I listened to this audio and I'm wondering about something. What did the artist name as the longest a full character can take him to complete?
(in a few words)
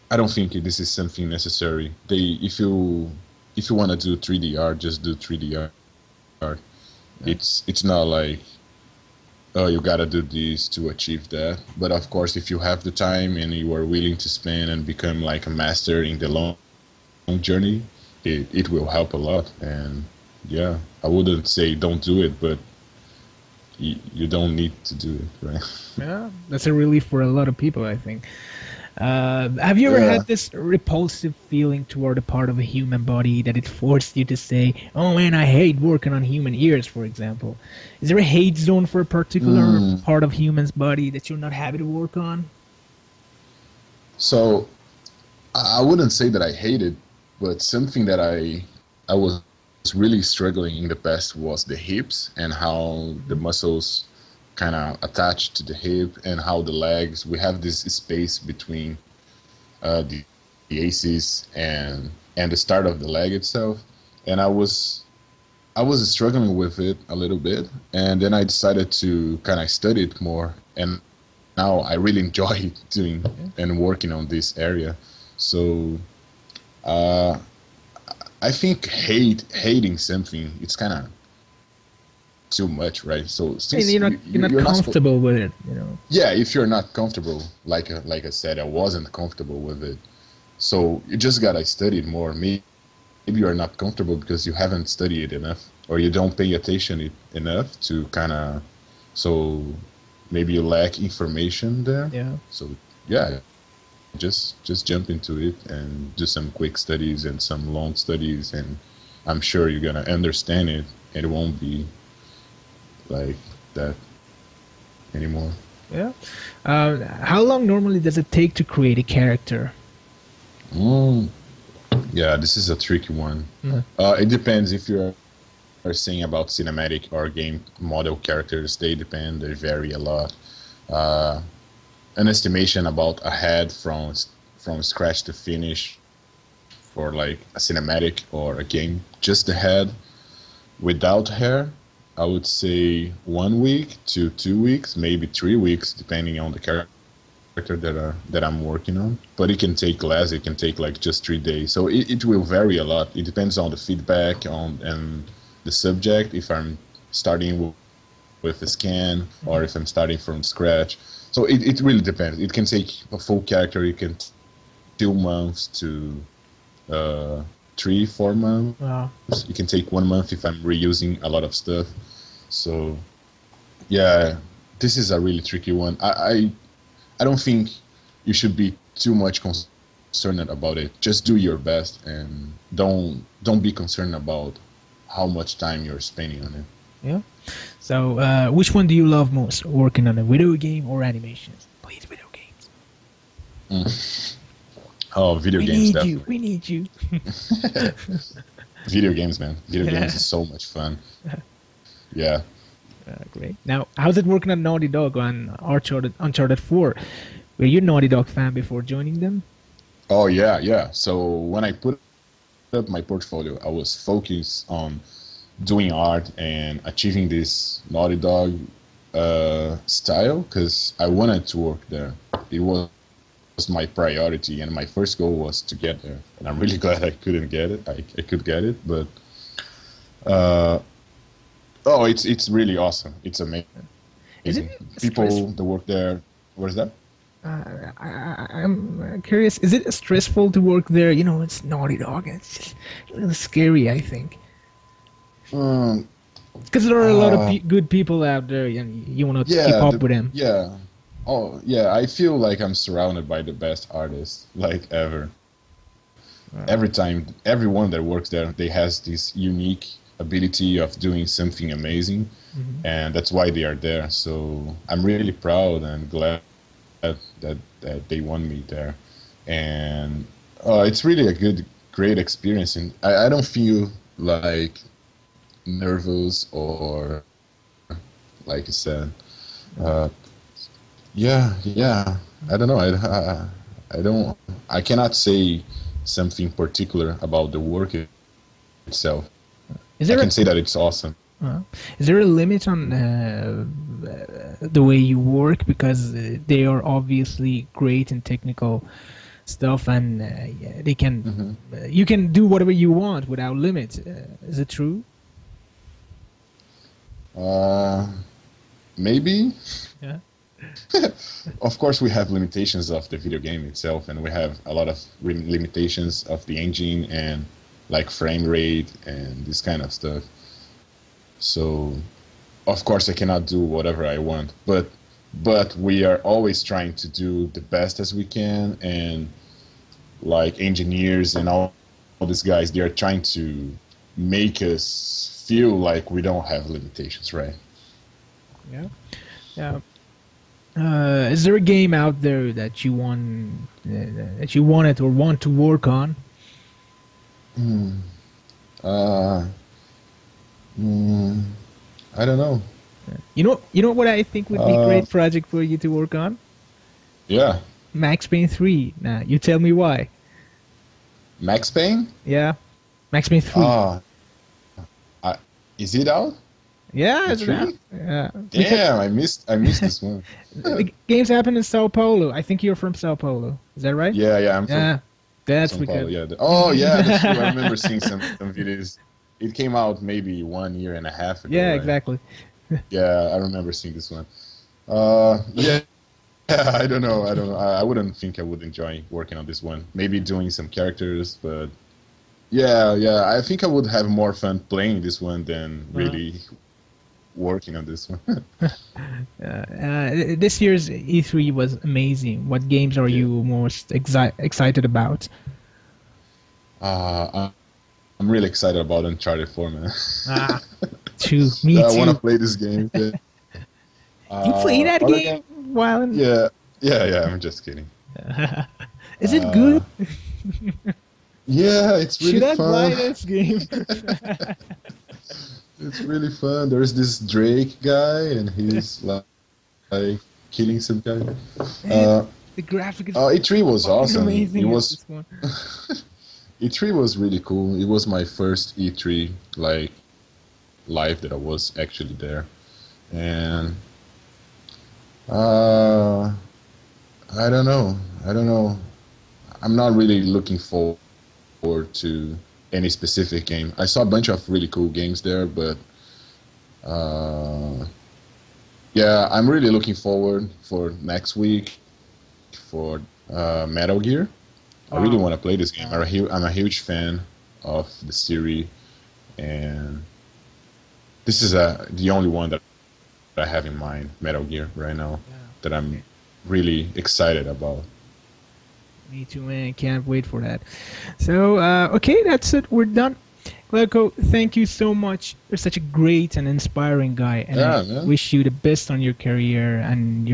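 4 months.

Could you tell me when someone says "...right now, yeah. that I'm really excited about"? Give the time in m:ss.
7:54.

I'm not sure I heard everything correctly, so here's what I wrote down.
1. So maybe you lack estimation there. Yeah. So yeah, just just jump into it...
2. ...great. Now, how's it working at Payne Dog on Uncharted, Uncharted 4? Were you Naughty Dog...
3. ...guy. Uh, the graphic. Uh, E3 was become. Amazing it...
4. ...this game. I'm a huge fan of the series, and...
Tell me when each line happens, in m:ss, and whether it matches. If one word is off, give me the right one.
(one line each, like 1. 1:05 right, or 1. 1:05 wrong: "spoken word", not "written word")
1. 1:39 wrong: "information", not "estimation"
2. 3:23 wrong: "Naughty", not "Payne"
3. 7:11 wrong: "awesome", not "become"
4. 7:45 right.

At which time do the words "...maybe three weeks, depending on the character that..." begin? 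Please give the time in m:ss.
2:24.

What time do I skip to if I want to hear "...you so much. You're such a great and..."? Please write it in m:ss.
8:04.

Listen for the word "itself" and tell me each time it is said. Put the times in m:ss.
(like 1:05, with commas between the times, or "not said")
1:03, 4:48, 5:13.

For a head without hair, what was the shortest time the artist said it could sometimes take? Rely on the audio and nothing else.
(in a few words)
3 days.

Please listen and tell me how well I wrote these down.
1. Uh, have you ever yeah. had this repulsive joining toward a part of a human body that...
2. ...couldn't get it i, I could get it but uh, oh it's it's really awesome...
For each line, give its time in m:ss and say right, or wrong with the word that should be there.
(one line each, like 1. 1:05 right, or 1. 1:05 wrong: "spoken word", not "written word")
1. 0:28 wrong: "feeling", not "joining"
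2. 3:47 right.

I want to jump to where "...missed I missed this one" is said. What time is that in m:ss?
6:09.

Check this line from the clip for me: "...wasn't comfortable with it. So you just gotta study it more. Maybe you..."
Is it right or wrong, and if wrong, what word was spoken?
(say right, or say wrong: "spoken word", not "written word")
right.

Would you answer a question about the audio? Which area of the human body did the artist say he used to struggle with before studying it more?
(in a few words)
hips.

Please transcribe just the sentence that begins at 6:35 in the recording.
really uh-huh working on this one.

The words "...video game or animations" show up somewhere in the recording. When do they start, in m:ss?
3:10.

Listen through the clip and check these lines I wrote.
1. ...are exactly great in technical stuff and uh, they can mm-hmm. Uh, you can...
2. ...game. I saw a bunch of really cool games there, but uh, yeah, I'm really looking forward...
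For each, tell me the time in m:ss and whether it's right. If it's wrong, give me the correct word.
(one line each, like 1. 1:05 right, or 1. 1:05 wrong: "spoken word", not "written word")
1. 4:56 wrong: "obviously", not "exactly"
2. 7:33 right.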